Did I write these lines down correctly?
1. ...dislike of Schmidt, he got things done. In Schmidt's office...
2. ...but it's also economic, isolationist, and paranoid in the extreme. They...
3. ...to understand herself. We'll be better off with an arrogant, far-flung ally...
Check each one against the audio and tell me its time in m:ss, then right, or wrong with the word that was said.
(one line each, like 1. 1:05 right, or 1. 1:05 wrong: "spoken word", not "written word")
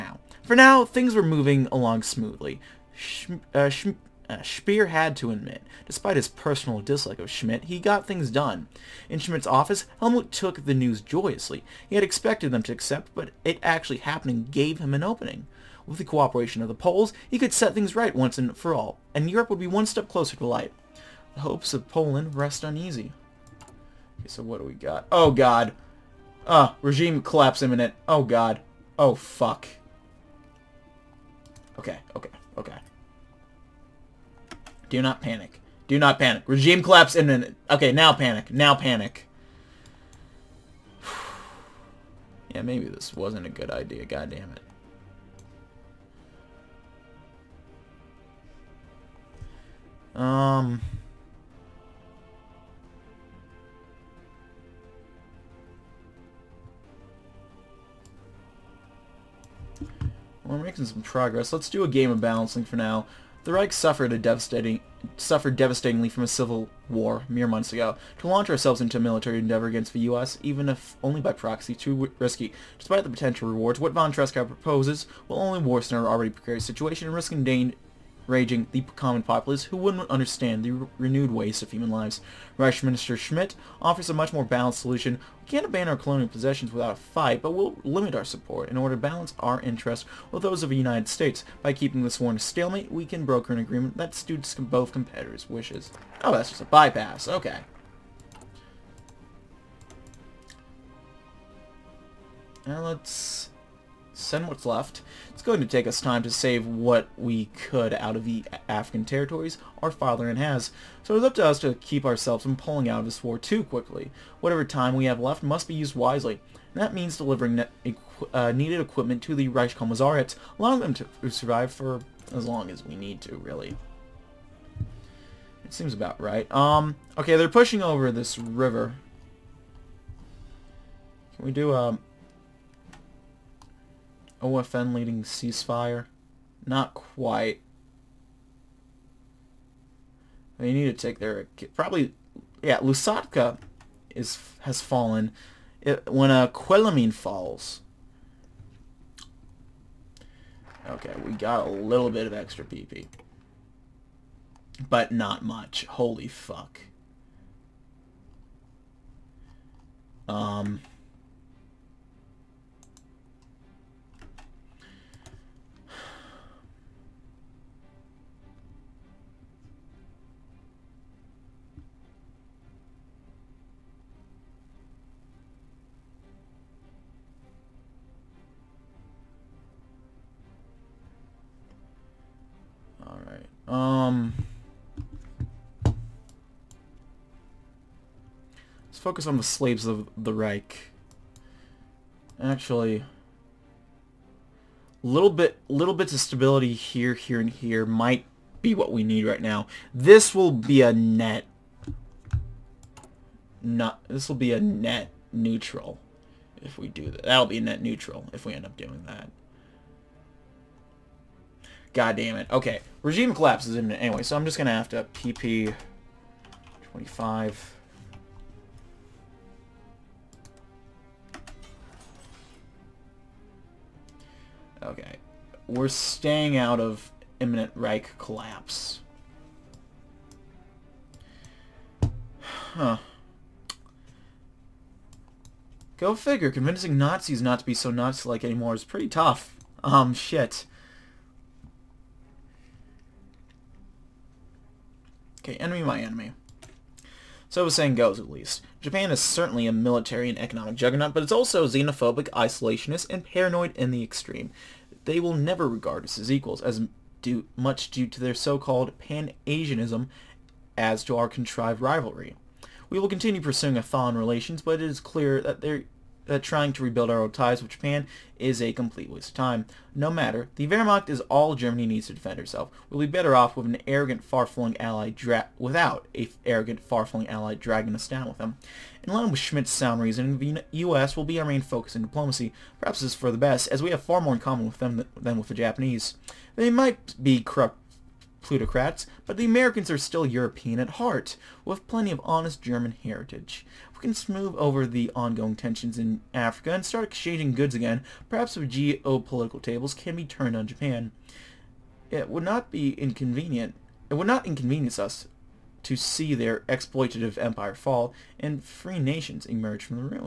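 1. 0:06 right
2. 4:11 wrong: "xenophobic", not "economic"
3. 4:32 wrong: "defend", not "understand".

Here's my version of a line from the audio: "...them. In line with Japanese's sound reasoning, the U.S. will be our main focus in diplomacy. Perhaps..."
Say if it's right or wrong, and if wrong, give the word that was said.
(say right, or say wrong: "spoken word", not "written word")
wrong: "Schmidt", not "Japanese".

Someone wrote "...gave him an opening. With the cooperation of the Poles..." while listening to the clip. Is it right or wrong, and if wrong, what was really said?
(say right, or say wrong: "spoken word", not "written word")
right.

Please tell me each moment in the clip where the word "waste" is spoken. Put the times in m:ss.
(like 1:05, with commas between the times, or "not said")
1:21, 4:29.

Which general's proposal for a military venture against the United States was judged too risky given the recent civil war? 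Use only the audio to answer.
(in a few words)
von Tresckow.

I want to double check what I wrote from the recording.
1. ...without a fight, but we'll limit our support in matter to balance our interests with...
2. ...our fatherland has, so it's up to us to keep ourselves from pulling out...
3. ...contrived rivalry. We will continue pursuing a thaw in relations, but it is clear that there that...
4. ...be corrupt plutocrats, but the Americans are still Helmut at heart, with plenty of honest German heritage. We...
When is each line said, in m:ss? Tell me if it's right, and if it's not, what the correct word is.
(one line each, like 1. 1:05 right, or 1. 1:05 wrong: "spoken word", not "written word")
1. 1:26 wrong: "order", not "matter"
2. 1:49 right
3. 4:21 right
4. 4:47 wrong: "European", not "Helmut".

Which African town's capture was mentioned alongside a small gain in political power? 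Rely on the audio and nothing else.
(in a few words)
Quelimane.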